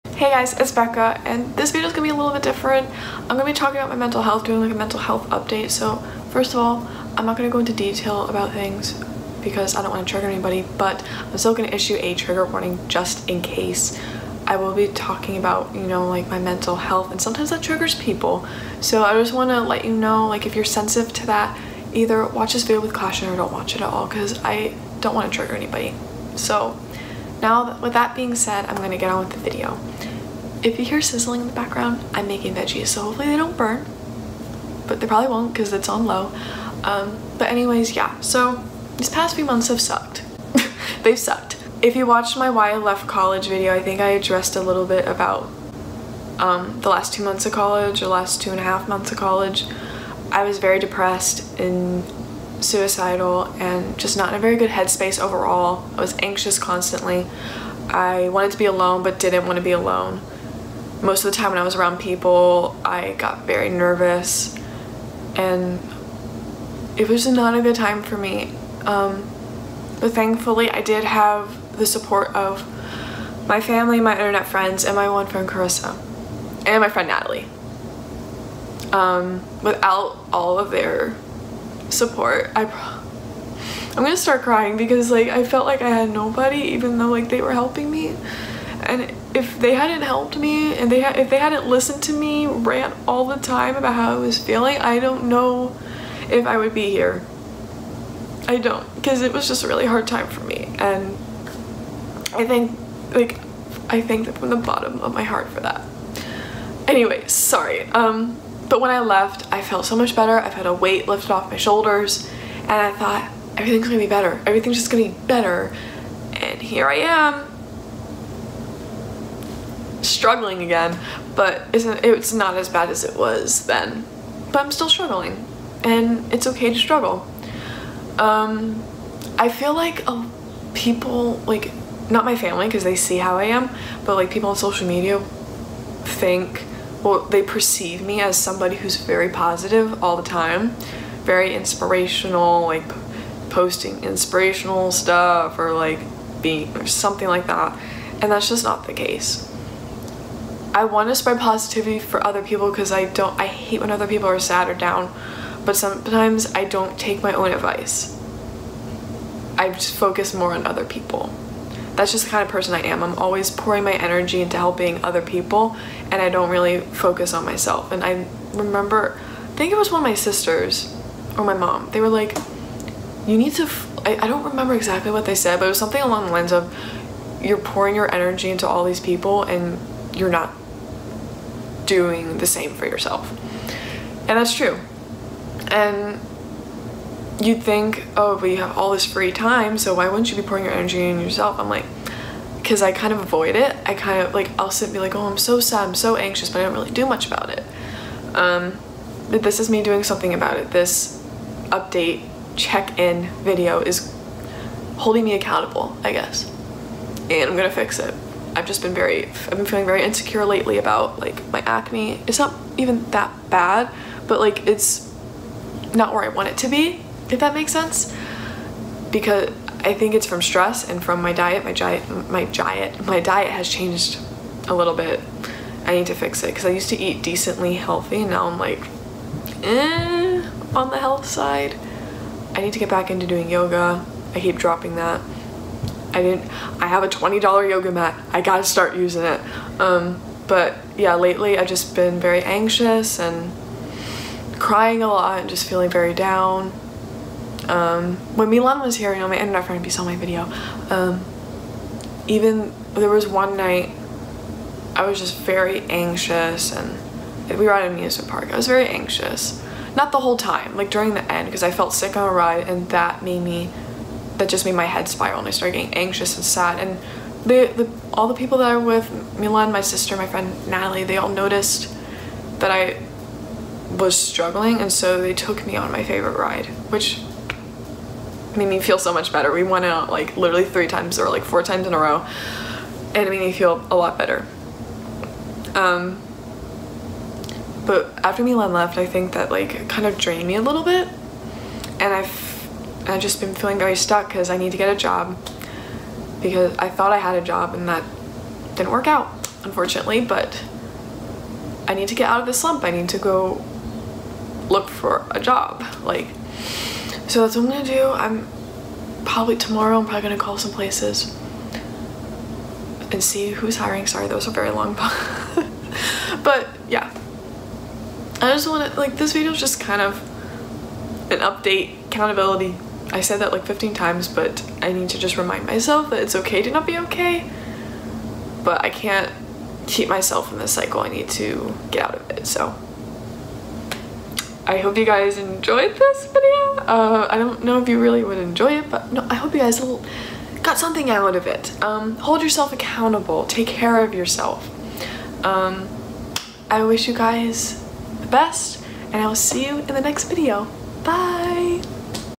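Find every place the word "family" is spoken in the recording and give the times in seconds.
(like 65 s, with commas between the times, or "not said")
73 s, 132 s.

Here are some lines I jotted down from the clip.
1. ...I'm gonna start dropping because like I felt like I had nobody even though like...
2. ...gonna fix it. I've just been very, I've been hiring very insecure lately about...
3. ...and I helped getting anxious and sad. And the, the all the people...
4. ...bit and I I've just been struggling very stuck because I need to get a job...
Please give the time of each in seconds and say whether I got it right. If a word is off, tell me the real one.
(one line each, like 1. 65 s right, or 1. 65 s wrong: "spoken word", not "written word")
1. 83 s wrong: "crying", not "dropping"
2. 207 s wrong: "feeling", not "hiring"
3. 265 s wrong: "started", not "helped"
4. 290 s wrong: "feeling", not "struggling".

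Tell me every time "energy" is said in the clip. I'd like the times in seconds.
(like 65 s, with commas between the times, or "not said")
163 s, 178 s, 190 s.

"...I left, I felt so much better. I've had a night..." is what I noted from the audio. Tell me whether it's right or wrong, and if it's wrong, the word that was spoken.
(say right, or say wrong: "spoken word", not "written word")
wrong: "weight", not "night".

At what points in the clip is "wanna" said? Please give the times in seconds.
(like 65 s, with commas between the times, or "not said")
9 s, 19 s, 25 s, 318 s.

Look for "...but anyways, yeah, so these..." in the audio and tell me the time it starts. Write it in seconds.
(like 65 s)
37 s.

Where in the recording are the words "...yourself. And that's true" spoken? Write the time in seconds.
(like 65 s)
182 s.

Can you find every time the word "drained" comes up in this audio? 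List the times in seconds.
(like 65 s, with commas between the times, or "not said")
290 s.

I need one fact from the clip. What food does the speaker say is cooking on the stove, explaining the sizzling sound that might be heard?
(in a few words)
veggies.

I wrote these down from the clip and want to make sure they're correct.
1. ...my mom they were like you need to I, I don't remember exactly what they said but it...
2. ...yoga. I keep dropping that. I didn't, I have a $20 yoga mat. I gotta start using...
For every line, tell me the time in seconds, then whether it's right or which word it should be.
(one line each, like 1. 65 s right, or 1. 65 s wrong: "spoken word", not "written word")
1. 171 s right
2. 233 s right.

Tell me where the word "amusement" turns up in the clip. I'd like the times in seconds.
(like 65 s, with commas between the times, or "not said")
257 s.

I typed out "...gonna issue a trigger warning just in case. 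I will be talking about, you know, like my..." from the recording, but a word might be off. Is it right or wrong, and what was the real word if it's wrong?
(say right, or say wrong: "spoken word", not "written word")
right.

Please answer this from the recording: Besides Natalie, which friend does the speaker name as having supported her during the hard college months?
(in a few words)
Carissa.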